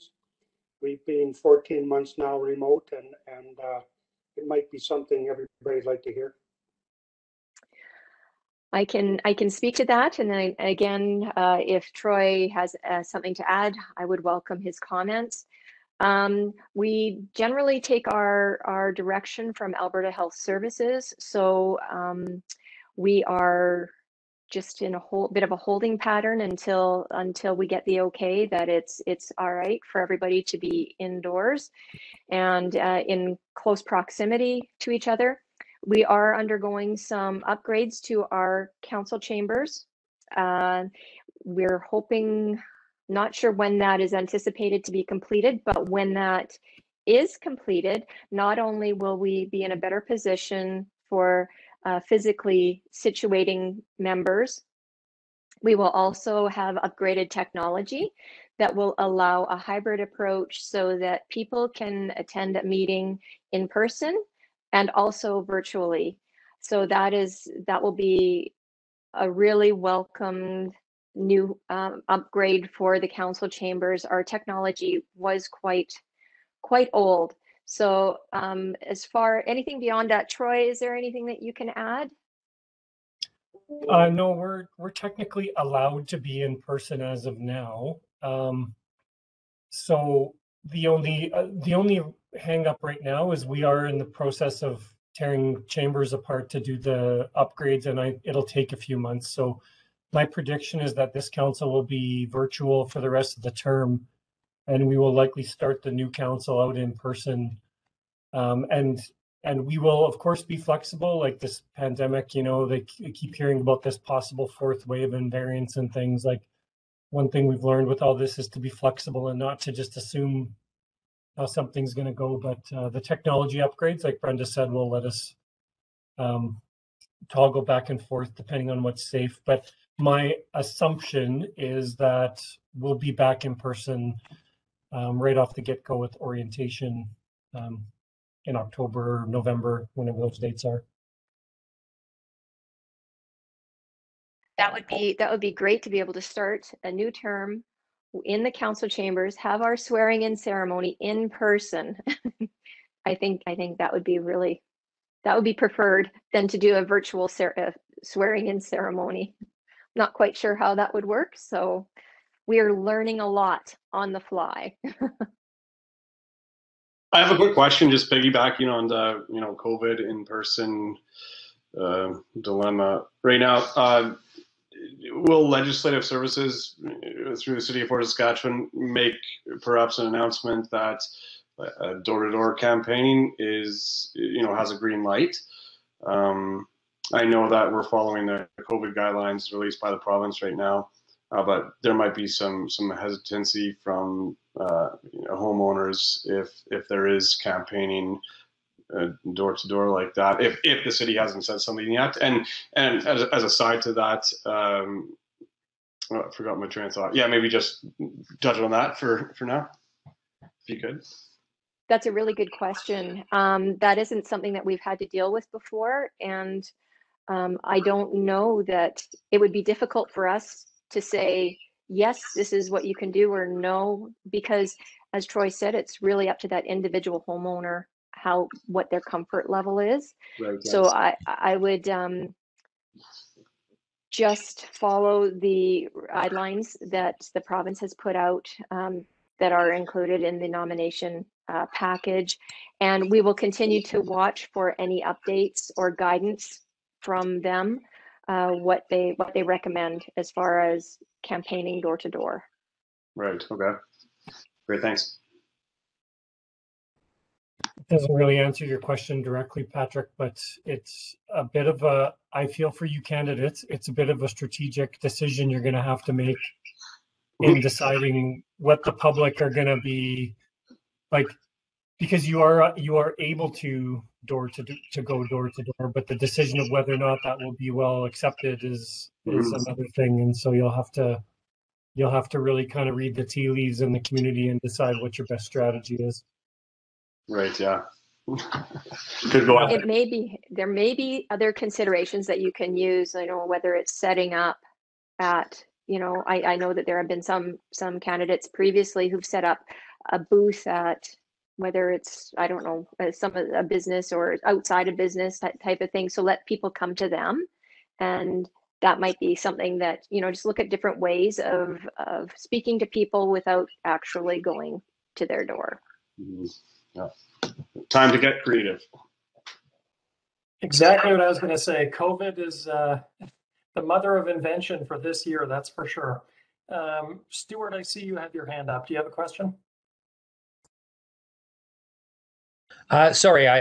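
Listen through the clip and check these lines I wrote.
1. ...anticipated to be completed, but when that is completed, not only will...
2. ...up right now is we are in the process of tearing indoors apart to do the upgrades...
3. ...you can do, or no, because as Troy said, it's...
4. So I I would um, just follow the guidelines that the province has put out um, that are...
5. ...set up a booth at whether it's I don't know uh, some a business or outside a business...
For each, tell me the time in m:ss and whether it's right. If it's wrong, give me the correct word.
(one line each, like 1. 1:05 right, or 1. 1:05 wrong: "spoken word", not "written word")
1. 0:44 right
2. 1:32 wrong: "chambers", not "indoors"
3. 3:42 right
4. 3:50 right
5. 4:59 right.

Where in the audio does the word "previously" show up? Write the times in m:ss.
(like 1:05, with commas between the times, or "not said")
4:58.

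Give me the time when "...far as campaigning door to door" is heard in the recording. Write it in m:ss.
4:10.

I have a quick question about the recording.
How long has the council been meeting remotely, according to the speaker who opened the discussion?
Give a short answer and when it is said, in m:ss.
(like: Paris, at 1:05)
14 months, at 0:01.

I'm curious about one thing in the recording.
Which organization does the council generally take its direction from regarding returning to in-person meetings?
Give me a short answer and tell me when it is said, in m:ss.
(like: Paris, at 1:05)
Alberta Health Services, at 0:19.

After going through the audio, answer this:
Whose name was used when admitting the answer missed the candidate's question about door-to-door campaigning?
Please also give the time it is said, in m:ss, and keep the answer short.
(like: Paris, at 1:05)
Patrick, at 4:19.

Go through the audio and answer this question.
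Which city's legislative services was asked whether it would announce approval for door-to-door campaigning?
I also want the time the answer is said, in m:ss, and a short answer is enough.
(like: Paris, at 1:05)
Fort Saskatchewan, at 2:57.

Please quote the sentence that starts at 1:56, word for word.
Like one thing we've learned with all this is to be flexible and not to just assume how something's going to go.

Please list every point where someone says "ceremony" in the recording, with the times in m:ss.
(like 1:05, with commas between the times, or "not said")
2:30, 2:38.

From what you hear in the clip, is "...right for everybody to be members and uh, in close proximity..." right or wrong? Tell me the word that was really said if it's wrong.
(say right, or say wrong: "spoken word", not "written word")
wrong: "indoors", not "members".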